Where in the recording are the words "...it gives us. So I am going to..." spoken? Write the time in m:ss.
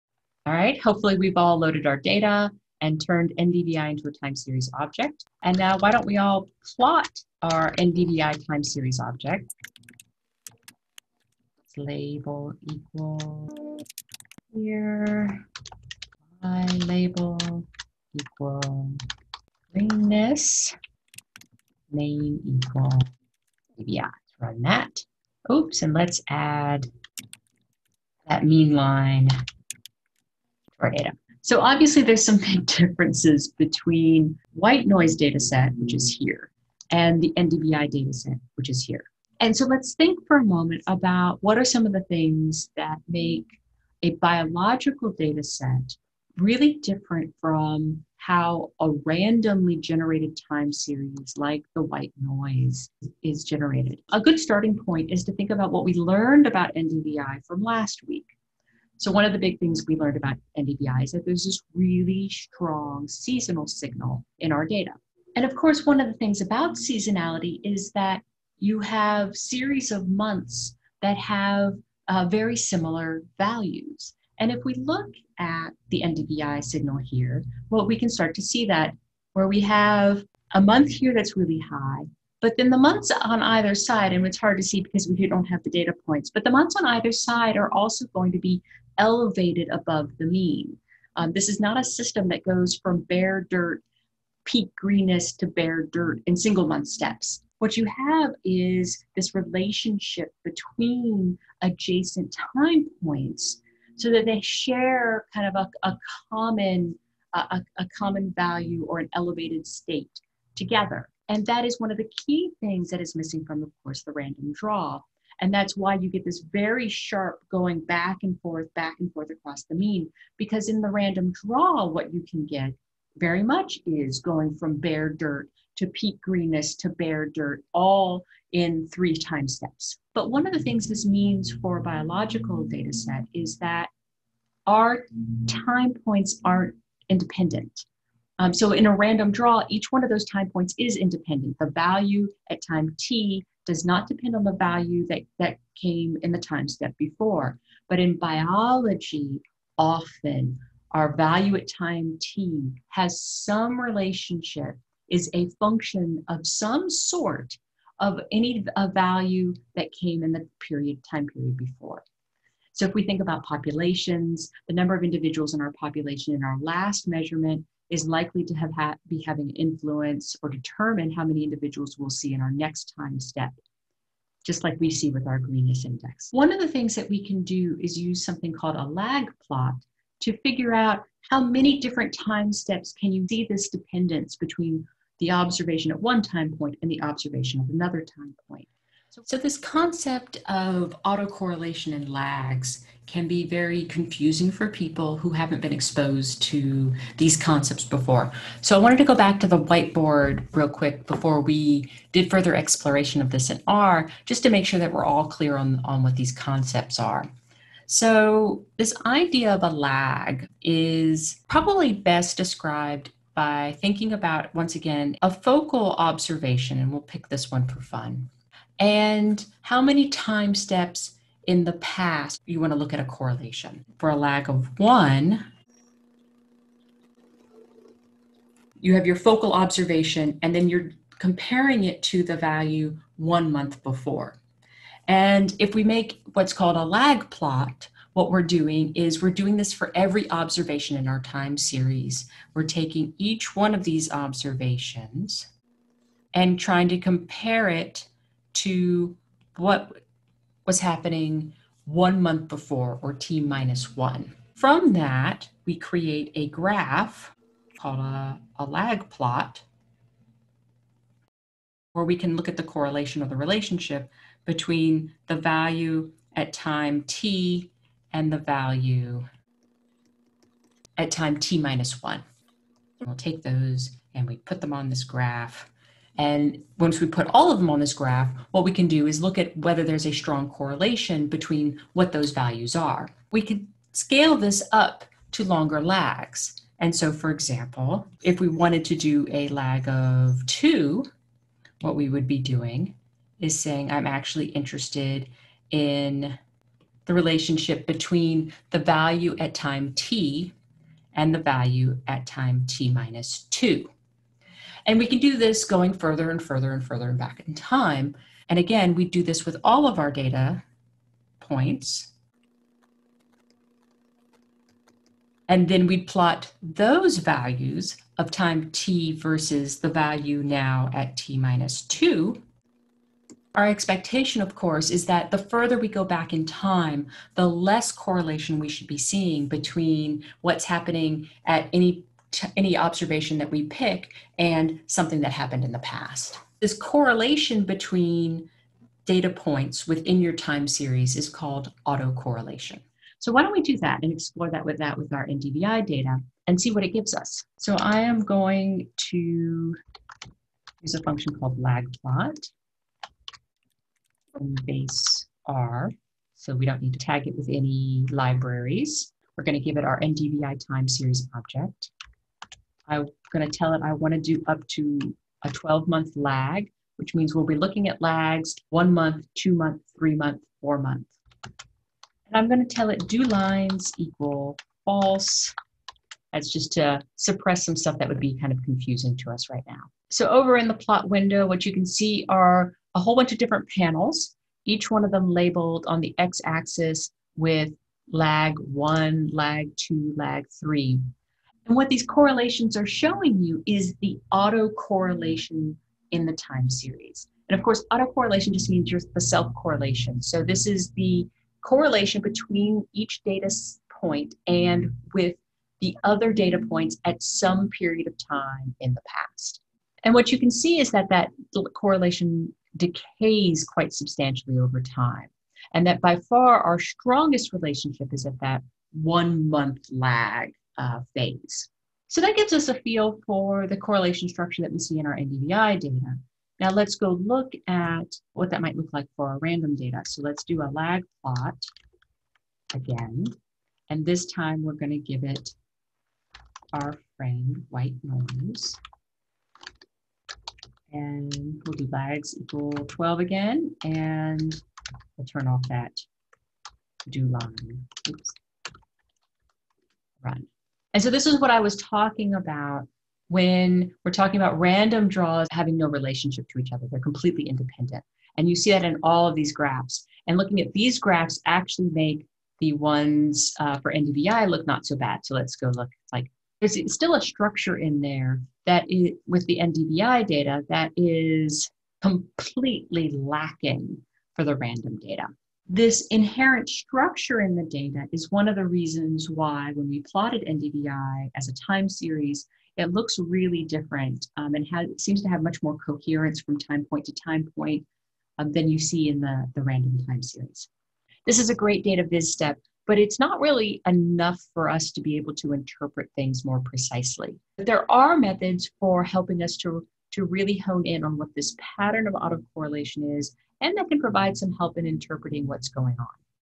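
5:46.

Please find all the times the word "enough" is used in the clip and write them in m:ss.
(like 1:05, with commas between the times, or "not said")
8:13.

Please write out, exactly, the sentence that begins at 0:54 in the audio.
A good starting point is to think about what we learned about NDVI from last week.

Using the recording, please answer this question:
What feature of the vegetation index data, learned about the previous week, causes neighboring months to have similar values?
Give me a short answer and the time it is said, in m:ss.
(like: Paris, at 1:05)
seasonal signal, at 1:03.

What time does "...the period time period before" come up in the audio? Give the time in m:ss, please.
2:40.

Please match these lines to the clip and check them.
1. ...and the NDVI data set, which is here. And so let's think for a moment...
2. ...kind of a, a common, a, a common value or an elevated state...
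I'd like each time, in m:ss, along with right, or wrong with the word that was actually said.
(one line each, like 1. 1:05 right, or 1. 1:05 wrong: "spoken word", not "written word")
1. 0:36 right
2. 1:45 right.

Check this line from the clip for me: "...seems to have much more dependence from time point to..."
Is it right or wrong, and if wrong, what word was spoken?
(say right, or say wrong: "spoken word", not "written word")
wrong: "coherence", not "dependence".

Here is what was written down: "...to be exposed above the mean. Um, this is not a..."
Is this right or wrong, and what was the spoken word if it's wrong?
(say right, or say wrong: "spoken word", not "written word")
wrong: "elevated", not "exposed".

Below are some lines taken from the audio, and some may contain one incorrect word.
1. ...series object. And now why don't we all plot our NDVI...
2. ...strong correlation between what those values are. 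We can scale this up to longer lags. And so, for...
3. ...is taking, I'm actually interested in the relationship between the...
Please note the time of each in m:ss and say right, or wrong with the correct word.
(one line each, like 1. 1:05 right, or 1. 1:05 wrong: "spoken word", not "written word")
1. 0:04 right
2. 4:40 right
3. 4:53 wrong: "saying", not "taking".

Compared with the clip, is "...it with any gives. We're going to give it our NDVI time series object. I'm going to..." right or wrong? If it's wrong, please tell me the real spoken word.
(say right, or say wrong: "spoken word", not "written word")
wrong: "libraries", not "gives".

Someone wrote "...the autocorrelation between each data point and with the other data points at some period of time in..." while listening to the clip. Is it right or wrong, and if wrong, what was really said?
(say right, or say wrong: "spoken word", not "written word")
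wrong: "correlation", not "autocorrelation".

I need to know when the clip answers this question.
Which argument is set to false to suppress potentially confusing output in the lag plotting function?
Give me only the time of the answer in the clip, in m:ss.
6:13.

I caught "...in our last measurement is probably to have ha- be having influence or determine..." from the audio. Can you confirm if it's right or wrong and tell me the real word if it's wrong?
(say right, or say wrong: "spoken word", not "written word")
wrong: "likely", not "probably".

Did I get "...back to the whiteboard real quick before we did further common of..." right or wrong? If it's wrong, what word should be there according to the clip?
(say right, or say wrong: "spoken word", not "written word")
wrong: "exploration", not "common".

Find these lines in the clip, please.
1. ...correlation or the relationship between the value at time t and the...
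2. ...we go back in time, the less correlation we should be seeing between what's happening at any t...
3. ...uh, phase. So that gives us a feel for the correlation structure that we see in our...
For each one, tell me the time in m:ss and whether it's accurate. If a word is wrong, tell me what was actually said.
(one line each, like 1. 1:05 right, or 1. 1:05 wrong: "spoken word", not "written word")
1. 4:22 right
2. 5:25 right
3. 7:00 right.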